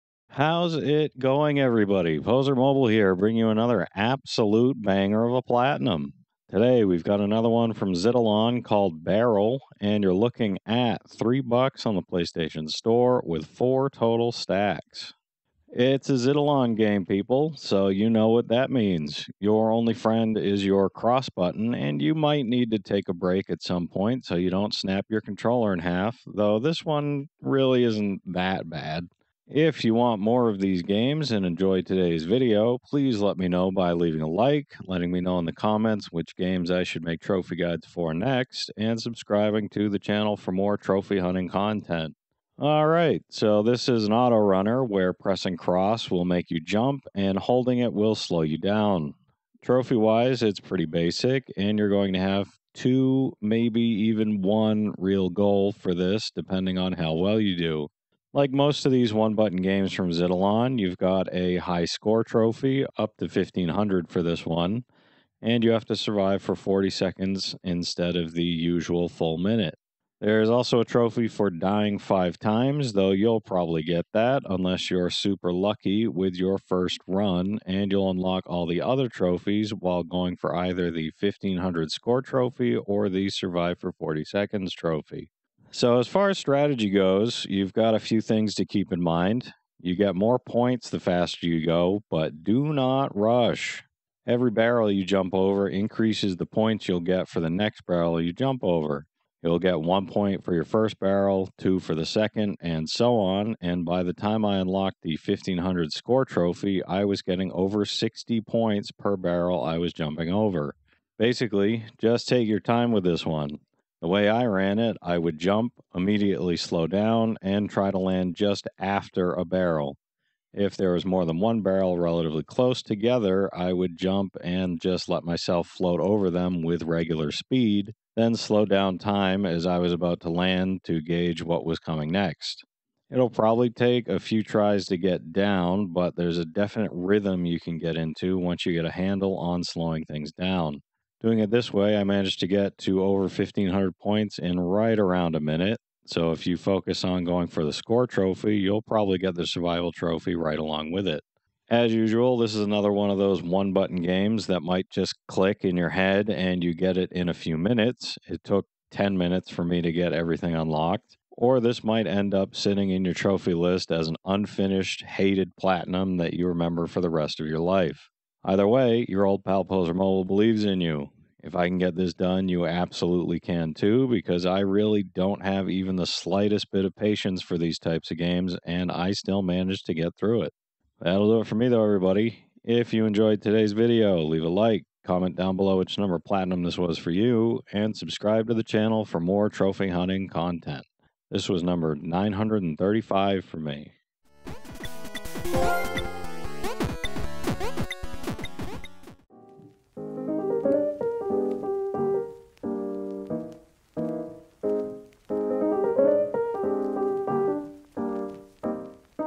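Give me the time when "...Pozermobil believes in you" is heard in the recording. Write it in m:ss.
2:49.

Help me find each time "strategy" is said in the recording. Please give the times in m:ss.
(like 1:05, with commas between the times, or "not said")
1:26.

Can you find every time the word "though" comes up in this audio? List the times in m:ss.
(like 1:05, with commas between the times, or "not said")
0:26, 1:12, 3:01.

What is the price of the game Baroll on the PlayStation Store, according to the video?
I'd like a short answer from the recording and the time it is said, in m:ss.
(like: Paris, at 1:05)
3 bucks, at 0:11.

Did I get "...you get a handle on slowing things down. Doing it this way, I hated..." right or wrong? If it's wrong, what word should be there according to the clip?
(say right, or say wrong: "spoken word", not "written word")
wrong: "managed", not "hated".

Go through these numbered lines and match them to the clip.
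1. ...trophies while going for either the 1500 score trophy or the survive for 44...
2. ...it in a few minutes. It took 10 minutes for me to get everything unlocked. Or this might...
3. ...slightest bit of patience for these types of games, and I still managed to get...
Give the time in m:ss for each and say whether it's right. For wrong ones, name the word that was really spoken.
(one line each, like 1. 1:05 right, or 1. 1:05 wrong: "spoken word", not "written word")
1. 1:19 wrong: "40", not "44"
2. 2:36 right
3. 2:56 right.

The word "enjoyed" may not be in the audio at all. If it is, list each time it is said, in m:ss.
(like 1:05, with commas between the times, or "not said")
0:31, 3:03.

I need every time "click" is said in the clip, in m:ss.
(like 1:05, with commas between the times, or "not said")
2:35.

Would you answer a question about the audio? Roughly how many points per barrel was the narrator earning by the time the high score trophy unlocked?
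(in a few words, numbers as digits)
over 60.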